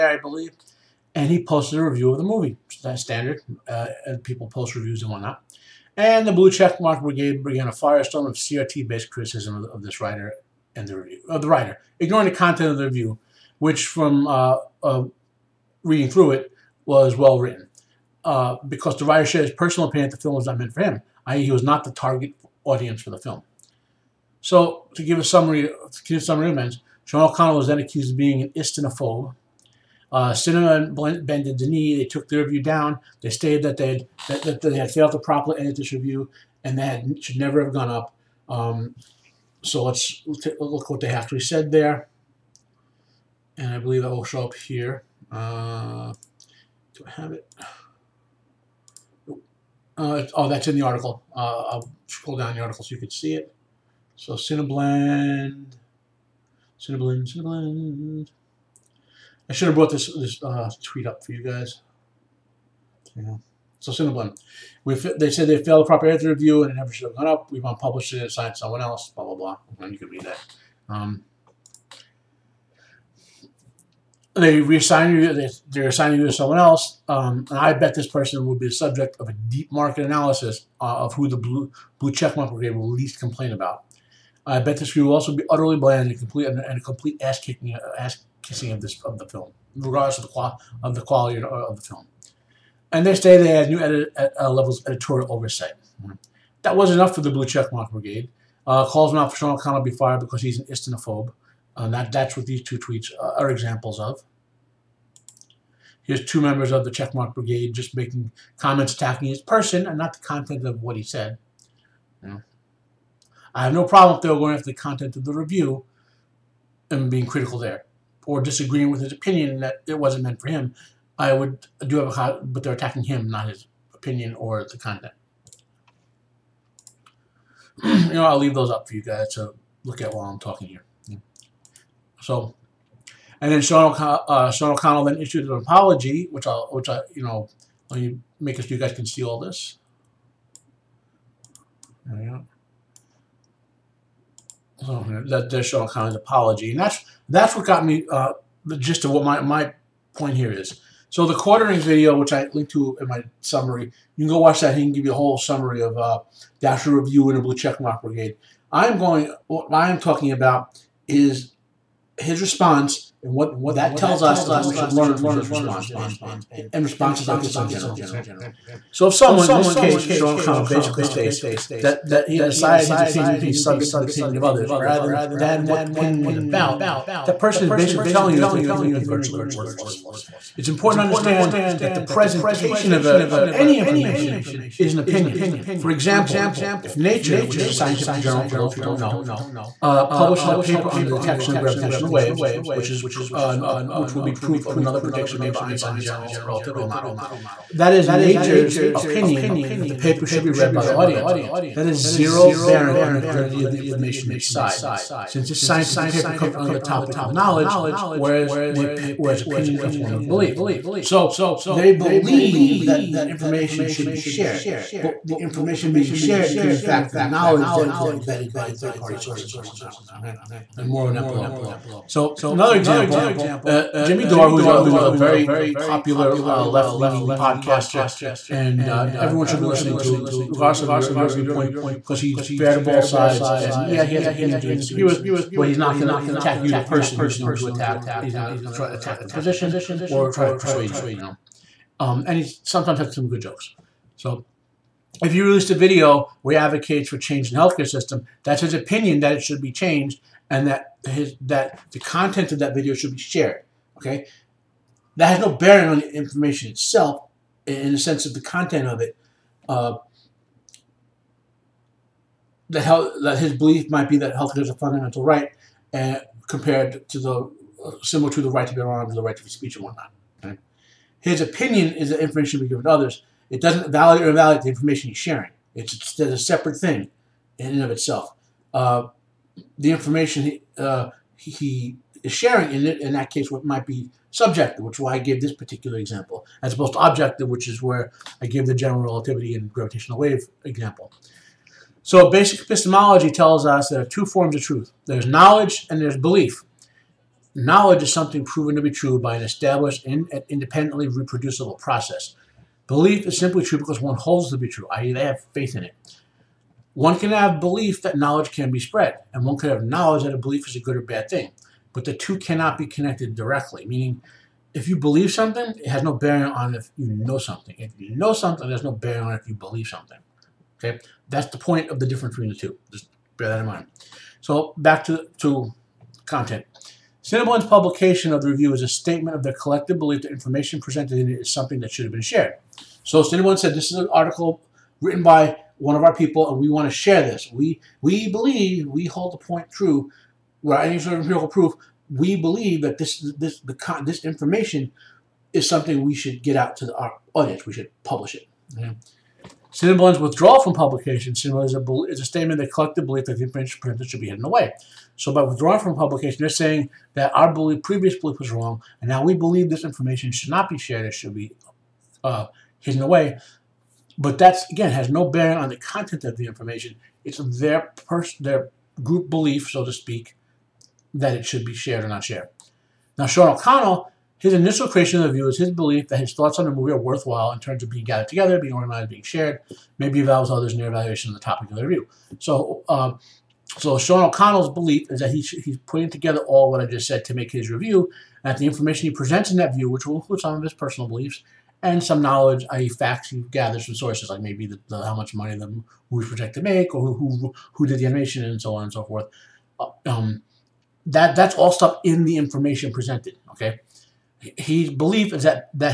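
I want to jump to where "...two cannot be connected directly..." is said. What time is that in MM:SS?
05:12.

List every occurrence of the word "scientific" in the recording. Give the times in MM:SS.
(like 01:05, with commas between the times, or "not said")
03:07, 03:25.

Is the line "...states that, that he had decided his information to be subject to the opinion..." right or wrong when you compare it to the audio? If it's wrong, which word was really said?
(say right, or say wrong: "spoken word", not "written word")
wrong: "opinion", not "information".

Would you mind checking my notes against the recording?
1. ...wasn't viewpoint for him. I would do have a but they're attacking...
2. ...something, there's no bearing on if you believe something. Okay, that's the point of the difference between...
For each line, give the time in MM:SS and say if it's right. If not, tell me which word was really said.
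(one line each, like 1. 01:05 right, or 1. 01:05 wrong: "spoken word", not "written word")
1. 01:59 wrong: "meant", not "viewpoint"
2. 05:18 right.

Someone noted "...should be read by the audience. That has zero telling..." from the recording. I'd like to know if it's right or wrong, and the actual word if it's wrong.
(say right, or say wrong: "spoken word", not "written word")
wrong: "bearing", not "telling".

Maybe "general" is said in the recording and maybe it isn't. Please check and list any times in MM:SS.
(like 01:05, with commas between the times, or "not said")
02:47, 03:16, 04:48.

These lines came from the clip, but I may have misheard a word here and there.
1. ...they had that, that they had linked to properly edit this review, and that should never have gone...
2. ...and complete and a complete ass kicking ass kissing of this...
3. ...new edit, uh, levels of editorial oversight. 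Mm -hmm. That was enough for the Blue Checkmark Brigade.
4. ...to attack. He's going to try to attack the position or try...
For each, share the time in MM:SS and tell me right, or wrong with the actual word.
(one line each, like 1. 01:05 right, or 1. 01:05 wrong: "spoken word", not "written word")
1. 00:33 wrong: "failed", not "linked"
2. 01:26 right
3. 01:33 right
4. 03:57 right.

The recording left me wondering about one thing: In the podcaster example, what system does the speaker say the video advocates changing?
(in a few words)
healthcare system.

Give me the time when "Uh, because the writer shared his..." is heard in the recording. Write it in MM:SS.
00:18.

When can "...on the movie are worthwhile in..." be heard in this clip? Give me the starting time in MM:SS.
06:16.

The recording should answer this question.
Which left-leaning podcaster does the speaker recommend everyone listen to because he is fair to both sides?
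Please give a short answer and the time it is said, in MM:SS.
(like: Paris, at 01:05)
Jimmy Dore, at 03:44.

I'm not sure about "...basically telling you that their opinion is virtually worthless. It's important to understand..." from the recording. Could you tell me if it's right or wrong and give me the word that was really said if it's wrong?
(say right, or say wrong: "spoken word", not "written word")
right.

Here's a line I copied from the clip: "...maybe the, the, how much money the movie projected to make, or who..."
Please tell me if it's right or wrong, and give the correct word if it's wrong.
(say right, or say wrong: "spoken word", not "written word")
right.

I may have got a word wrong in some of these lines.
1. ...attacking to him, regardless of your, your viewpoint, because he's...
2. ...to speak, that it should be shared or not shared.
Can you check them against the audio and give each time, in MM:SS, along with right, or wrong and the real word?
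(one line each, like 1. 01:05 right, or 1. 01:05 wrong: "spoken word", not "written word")
1. 03:49 wrong: "listening", not "attacking"
2. 06:09 right.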